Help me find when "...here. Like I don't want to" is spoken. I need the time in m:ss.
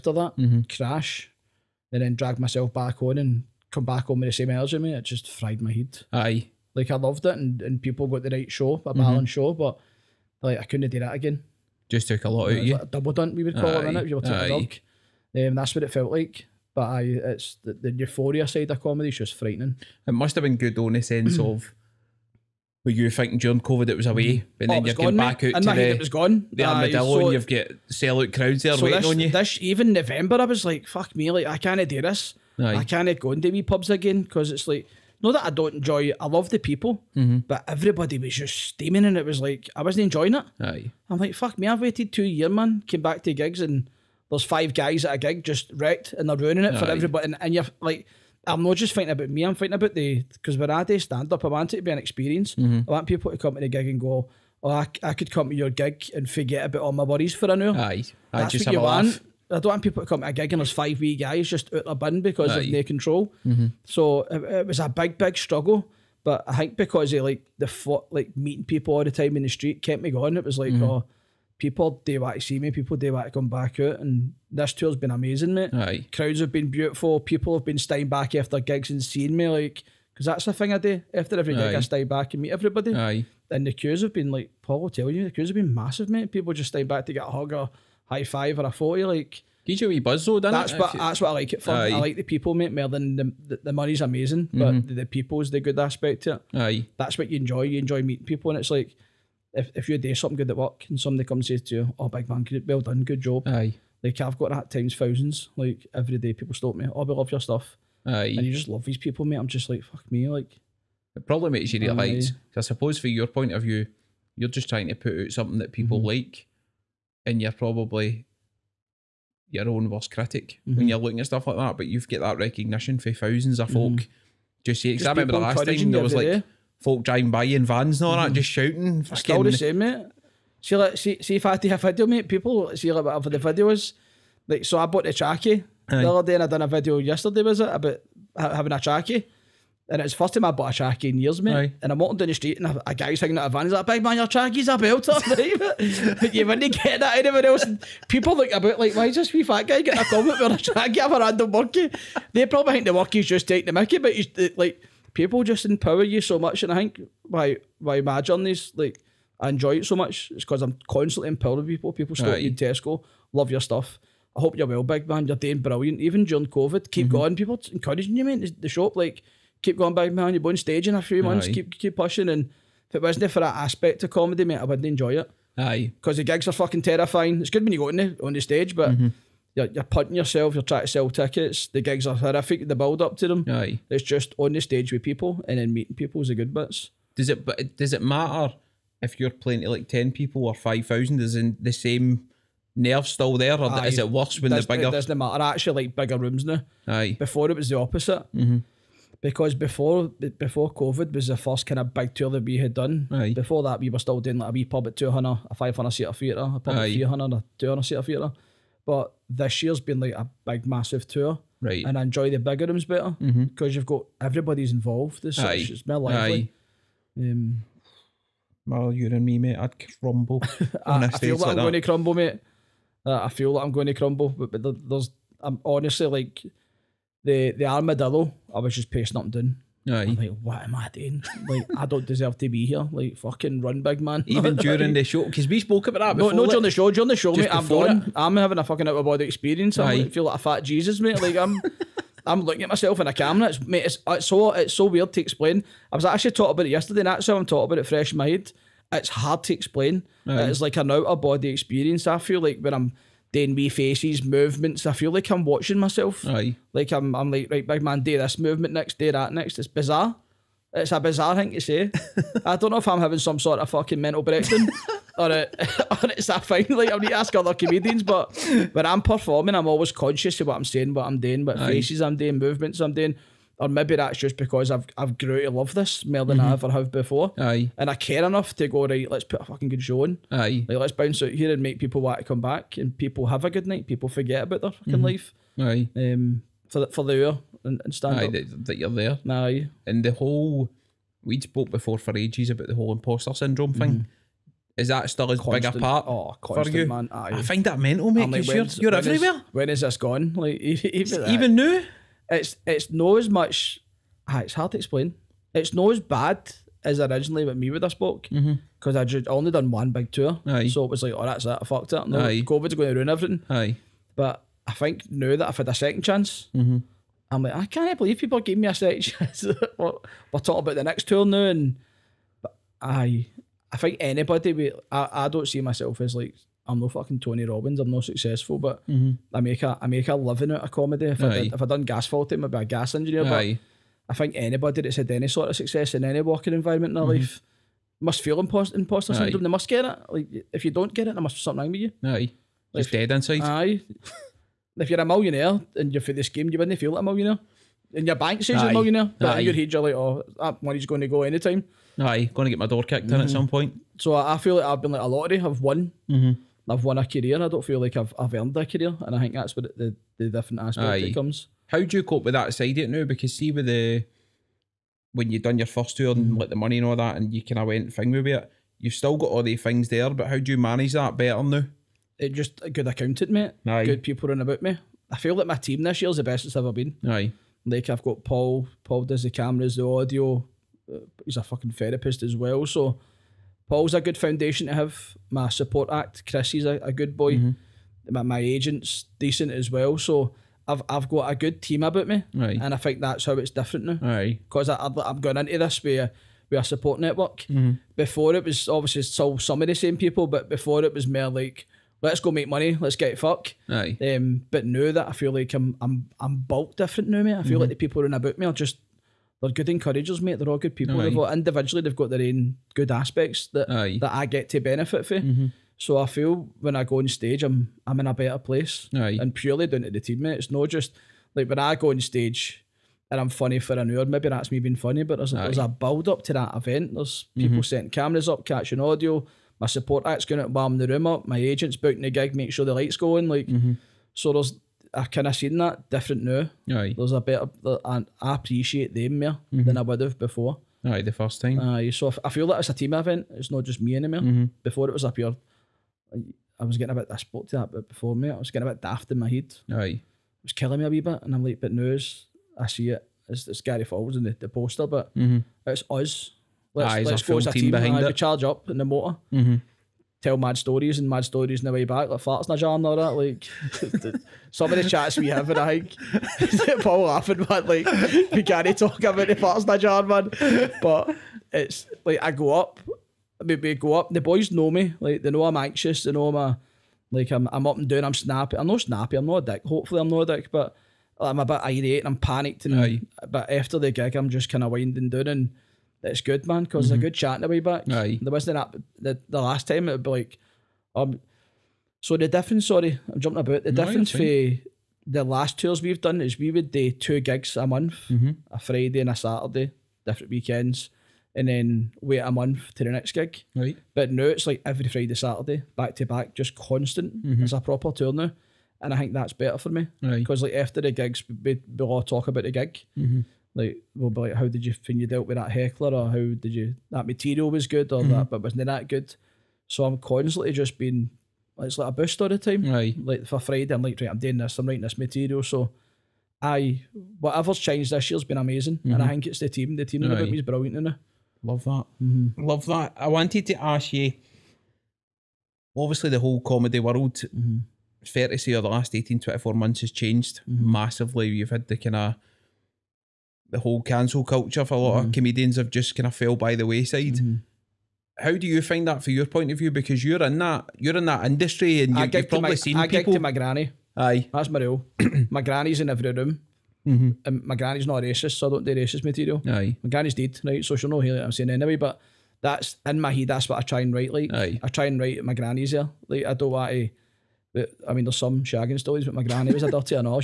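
9:25.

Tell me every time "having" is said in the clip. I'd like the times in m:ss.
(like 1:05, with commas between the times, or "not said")
2:18, 3:58, 4:22.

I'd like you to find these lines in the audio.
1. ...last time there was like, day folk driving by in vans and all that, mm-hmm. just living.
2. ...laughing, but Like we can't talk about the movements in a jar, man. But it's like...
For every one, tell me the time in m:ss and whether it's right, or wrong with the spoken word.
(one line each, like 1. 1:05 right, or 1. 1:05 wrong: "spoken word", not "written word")
1. 2:05 wrong: "shouting", not "living"
2. 7:47 wrong: "farts", not "movements".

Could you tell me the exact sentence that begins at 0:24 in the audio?
but then oh, you're gone, getting back out and to it was gone.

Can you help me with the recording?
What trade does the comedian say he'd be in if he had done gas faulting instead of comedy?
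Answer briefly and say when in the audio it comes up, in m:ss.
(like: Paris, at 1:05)
gas engineer, at 5:32.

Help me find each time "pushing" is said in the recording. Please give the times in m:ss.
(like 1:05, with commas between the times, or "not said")
2:51.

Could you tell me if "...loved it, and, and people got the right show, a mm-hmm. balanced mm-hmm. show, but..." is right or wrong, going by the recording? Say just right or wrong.
right.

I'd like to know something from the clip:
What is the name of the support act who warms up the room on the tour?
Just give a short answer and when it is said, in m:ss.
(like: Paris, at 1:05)
Chris, at 6:26.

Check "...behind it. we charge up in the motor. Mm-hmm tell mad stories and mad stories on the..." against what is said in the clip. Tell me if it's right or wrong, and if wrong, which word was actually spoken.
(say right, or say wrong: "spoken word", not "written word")
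right.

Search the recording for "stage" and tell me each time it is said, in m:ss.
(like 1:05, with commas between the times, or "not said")
2:50, 2:58, 3:04, 6:57, 7:02.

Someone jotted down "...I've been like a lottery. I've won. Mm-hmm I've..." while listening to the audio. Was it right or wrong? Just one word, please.
right.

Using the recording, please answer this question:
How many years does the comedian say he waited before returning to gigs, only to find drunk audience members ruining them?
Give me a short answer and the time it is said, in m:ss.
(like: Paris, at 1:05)
2, at 0:42.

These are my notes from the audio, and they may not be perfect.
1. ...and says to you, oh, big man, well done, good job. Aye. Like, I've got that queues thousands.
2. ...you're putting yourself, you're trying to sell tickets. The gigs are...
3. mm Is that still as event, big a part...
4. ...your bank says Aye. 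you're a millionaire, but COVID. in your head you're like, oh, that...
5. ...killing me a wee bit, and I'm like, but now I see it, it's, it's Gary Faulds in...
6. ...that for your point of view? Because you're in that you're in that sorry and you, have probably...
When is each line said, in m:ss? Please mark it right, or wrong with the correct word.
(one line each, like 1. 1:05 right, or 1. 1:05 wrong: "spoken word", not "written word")
1. 1:41 wrong: "times", not "queues"
2. 2:59 right
3. 4:53 wrong: "constant", not "event"
4. 5:48 wrong: "Aye", not "COVID"
5. 7:30 right
6. 9:08 wrong: "industry", not "sorry".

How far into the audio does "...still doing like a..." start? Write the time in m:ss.
3:23.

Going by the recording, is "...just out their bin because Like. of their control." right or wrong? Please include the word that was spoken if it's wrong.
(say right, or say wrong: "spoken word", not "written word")
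wrong: "Aye", not "Like".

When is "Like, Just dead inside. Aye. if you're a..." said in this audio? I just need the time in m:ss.
5:42.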